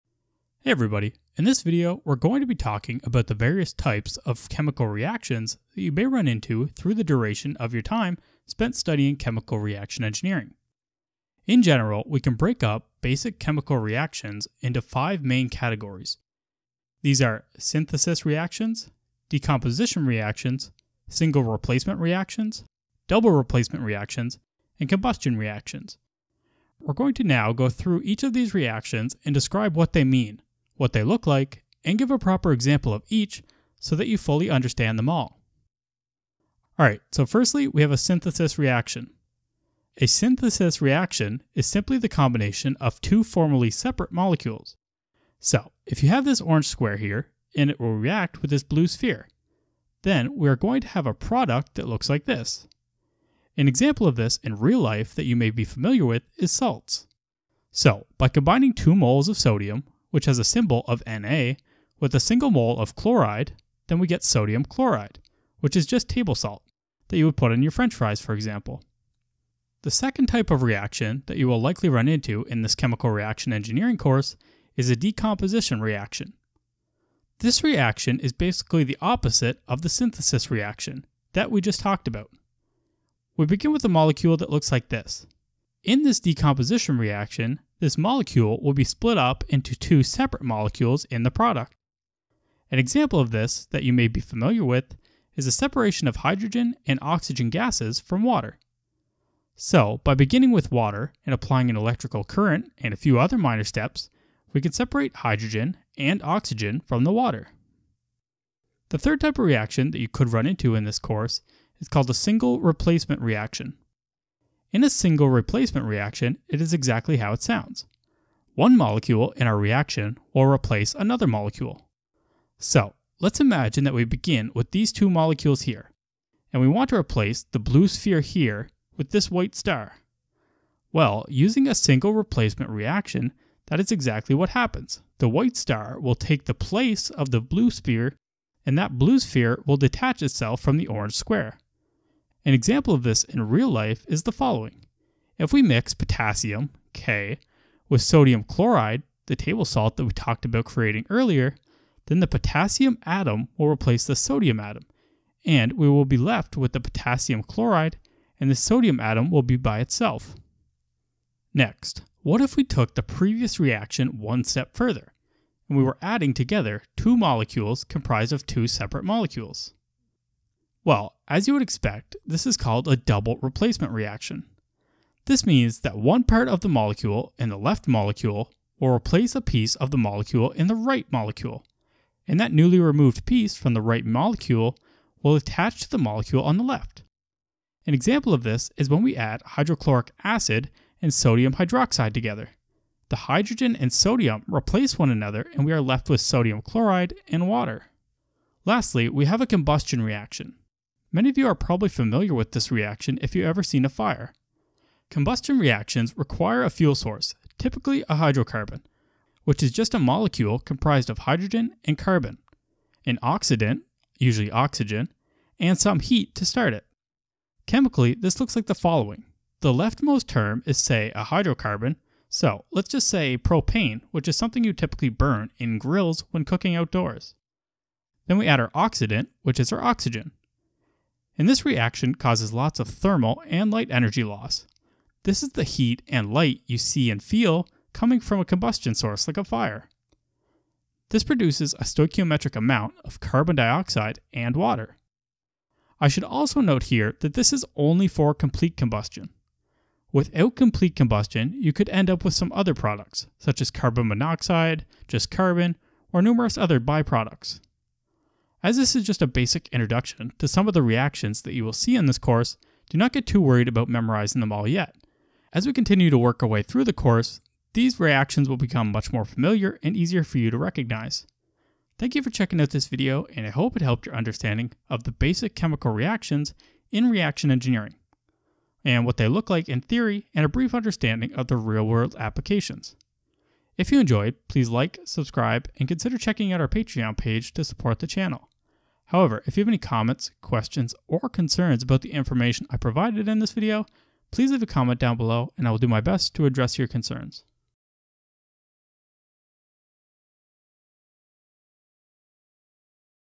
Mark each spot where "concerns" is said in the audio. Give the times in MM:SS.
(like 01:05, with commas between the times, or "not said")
04:51, 04:56.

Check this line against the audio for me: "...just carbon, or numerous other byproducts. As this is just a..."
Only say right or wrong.
right.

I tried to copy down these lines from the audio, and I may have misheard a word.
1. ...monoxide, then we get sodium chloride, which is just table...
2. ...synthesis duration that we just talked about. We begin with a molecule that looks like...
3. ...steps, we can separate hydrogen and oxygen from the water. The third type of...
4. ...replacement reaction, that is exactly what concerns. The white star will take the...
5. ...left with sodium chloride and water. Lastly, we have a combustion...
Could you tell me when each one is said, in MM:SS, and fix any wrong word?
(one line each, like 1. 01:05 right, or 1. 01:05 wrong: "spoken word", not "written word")
1. 01:02 wrong: "chloride", not "monoxide"
2. 01:19 wrong: "reaction", not "duration"
3. 01:43 right
4. 02:12 wrong: "happens", not "concerns"
5. 03:15 right.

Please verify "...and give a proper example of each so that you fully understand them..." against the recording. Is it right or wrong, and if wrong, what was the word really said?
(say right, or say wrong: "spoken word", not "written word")
right.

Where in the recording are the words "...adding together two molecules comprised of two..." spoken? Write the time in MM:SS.
02:46.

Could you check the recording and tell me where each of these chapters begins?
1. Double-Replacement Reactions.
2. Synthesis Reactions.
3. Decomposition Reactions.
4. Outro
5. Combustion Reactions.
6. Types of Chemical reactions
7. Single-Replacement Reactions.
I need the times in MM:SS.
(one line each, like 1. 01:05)
1. 02:45
2. 00:35
3. 01:11
4. 04:44
5. 03:17
6. 00:10
7. 01:53.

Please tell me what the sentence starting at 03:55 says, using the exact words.
This is the heat and light you see and feel coming from a combustion source like a fire.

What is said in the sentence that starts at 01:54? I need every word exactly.
In a single replacement reaction, it is exactly how it sounds.